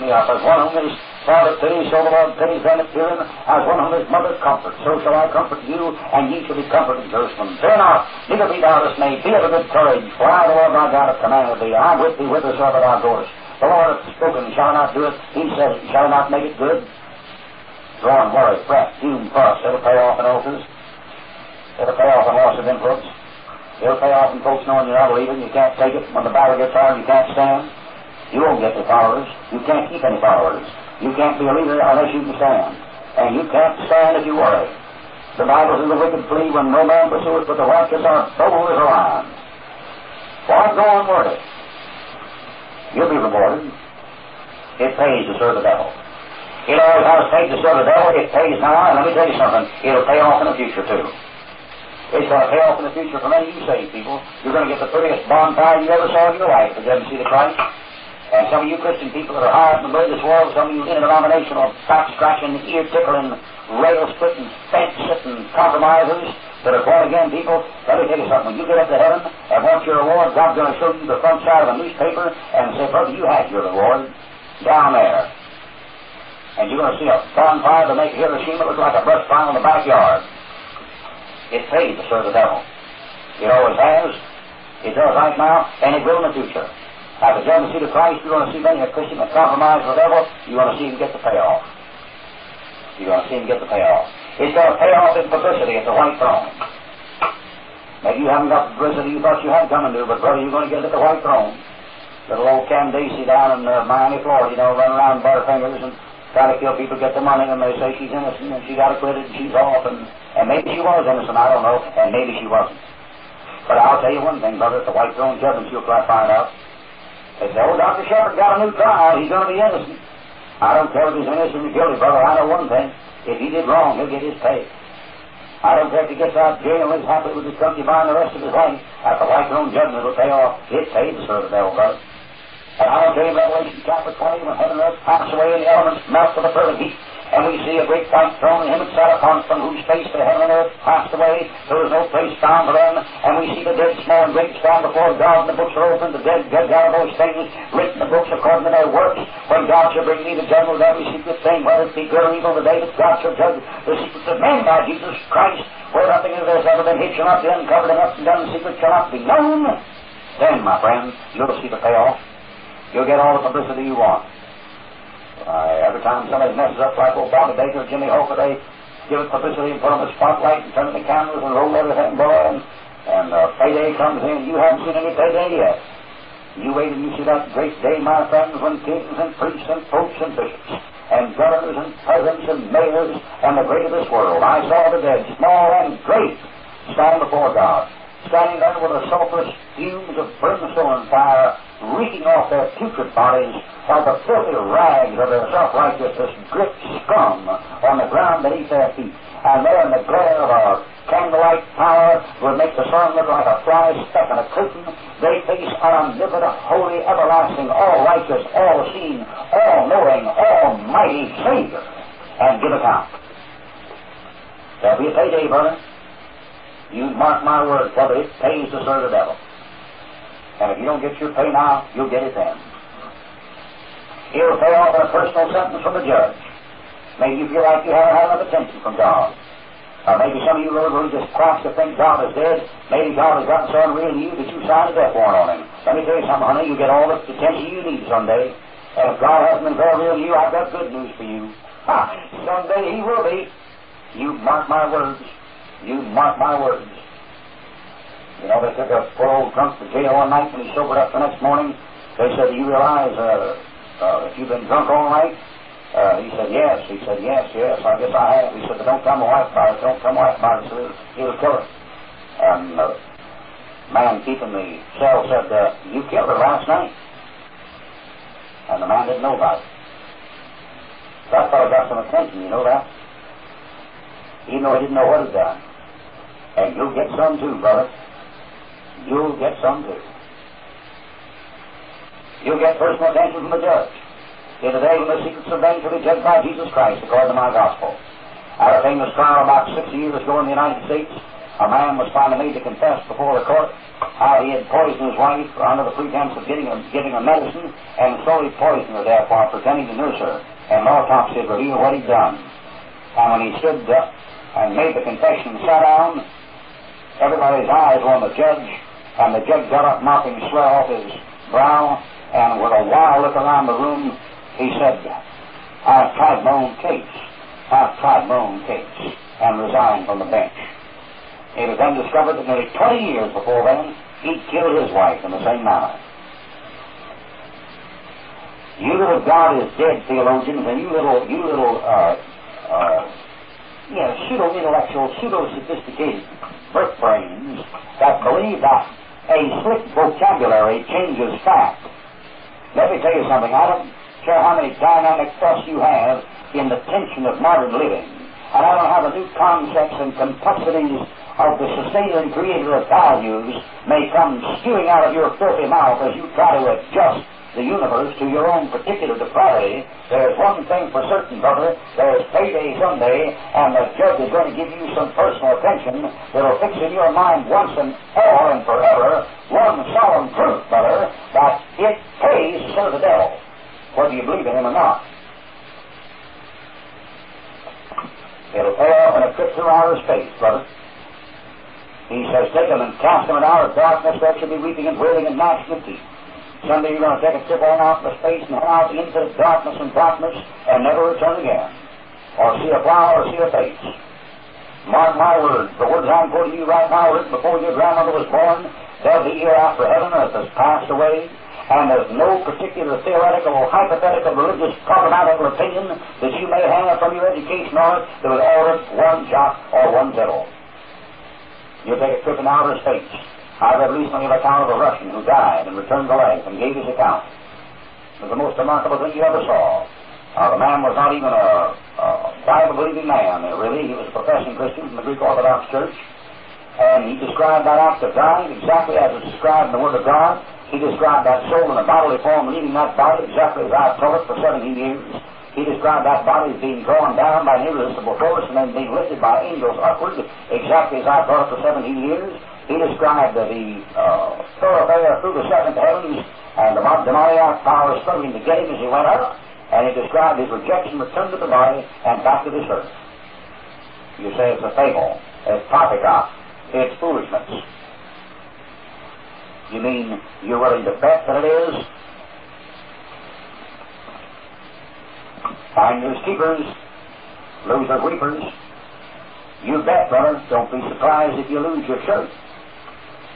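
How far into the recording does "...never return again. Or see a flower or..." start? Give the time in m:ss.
6:30.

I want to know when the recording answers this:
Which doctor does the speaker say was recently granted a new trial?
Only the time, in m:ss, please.
1:57.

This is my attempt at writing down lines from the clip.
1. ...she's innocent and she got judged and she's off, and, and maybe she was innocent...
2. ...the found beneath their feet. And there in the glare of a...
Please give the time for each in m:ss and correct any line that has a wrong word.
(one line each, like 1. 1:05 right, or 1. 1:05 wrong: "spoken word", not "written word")
1. 1:47 wrong: "acquitted", not "judged"
2. 3:17 wrong: "ground", not "found".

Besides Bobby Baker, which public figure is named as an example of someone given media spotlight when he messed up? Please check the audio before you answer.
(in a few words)
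Jimmy Hoffa.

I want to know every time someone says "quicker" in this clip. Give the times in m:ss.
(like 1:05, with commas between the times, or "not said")
not said.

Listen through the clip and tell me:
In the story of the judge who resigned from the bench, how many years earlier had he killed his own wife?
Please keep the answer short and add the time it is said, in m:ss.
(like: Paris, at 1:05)
20, at 5:22.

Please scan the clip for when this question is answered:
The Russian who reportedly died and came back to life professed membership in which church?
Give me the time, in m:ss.
7:05.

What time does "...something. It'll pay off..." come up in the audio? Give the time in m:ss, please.
0:49.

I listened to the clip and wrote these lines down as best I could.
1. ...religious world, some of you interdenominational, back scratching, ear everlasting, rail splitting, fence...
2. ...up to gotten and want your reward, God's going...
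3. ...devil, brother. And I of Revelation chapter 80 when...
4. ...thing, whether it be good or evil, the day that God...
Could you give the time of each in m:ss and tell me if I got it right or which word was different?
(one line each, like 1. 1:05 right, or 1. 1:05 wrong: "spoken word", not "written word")
1. 0:59 wrong: "tickling", not "everlasting"
2. 1:08 wrong: "heaven", not "gotten"
3. 2:11 wrong: "20", not "80"
4. 2:31 right.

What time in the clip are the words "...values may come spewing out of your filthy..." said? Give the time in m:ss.
5:52.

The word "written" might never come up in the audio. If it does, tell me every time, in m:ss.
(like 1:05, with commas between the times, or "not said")
2:27, 6:37.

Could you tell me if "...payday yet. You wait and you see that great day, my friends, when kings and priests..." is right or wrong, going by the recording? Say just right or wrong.
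right.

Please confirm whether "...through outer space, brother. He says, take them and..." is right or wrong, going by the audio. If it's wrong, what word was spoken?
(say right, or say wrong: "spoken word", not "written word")
right.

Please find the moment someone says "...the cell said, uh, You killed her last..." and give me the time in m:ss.
4:24.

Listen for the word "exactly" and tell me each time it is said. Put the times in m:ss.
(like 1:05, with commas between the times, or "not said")
7:08, 7:13, 7:20.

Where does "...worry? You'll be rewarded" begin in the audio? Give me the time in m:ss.
0:41.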